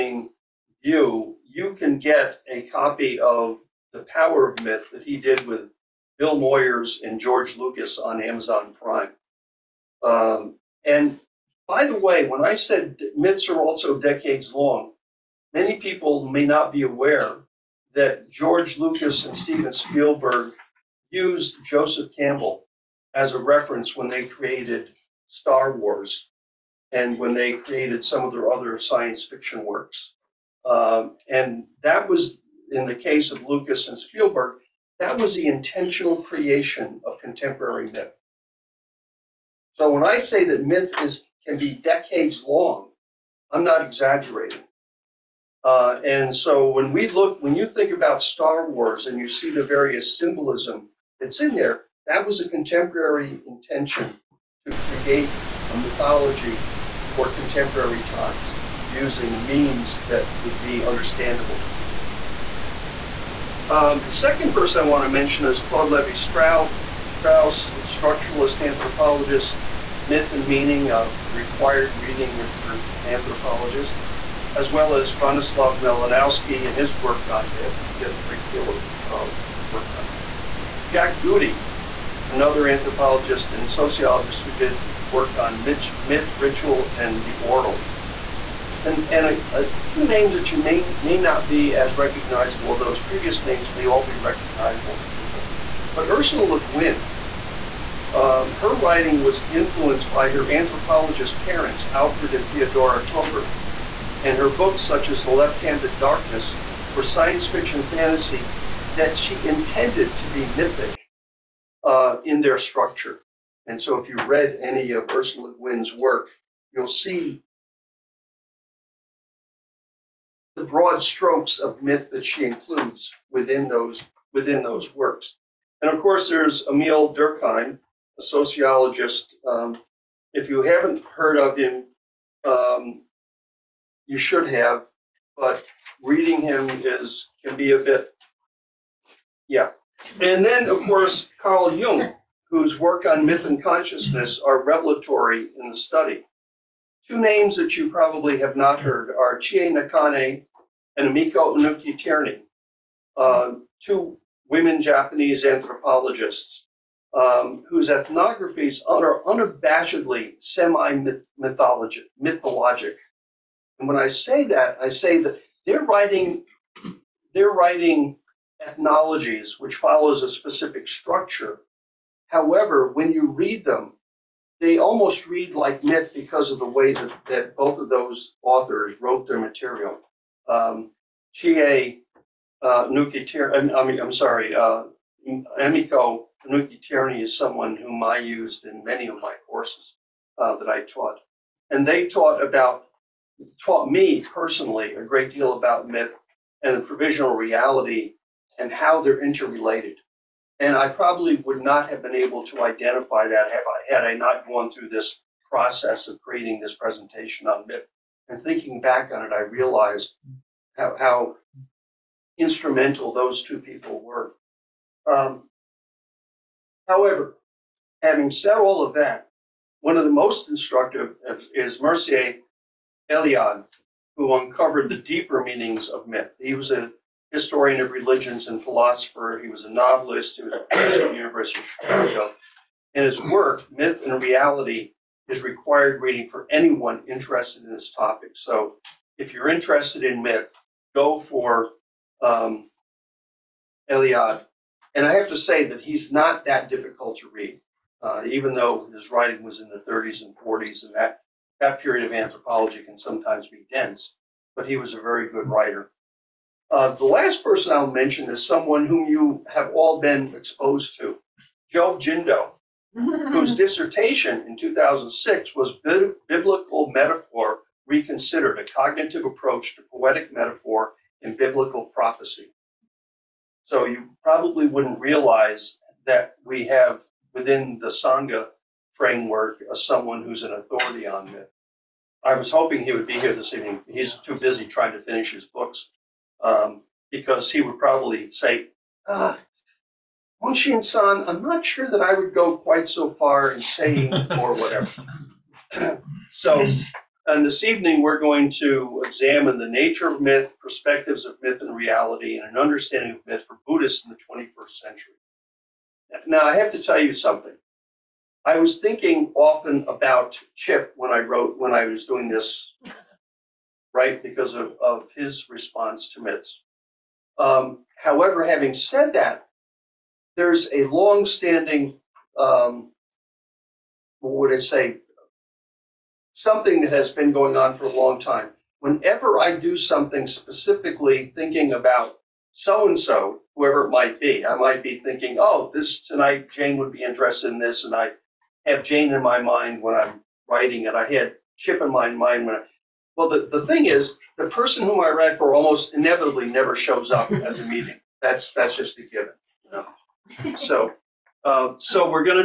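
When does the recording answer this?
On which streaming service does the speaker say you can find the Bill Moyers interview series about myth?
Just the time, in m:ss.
0:08.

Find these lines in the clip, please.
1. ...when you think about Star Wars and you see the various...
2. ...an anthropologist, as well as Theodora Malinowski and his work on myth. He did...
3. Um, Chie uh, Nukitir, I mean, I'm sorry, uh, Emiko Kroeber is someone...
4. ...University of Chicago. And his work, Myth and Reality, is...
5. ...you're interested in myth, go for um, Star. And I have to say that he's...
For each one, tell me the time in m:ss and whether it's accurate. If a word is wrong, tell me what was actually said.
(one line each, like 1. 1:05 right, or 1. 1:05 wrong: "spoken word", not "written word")
1. 0:47 right
2. 1:12 wrong: "Bronislaw", not "Theodora"
3. 3:00 wrong: "Nuki", not "Kroeber"
4. 3:51 right
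5. 3:59 wrong: "Eliade", not "Star".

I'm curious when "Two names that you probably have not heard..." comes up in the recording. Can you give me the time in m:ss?
2:27.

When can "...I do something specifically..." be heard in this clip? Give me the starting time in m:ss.
5:29.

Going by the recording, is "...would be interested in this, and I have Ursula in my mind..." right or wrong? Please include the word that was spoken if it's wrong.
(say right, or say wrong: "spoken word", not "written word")
wrong: "Jane", not "Ursula".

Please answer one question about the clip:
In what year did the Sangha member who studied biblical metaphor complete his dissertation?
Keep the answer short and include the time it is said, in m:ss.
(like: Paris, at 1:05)
2006, at 4:24.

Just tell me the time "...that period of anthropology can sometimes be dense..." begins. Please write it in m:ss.
4:11.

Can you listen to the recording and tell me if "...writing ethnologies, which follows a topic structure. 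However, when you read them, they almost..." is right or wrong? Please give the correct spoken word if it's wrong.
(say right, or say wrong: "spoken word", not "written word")
wrong: "specific", not "topic".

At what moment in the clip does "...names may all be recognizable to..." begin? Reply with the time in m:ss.
1:33.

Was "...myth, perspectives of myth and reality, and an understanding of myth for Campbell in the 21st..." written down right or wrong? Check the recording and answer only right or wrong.
wrong.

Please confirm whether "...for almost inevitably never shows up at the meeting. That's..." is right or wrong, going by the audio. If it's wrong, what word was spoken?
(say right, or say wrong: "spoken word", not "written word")
right.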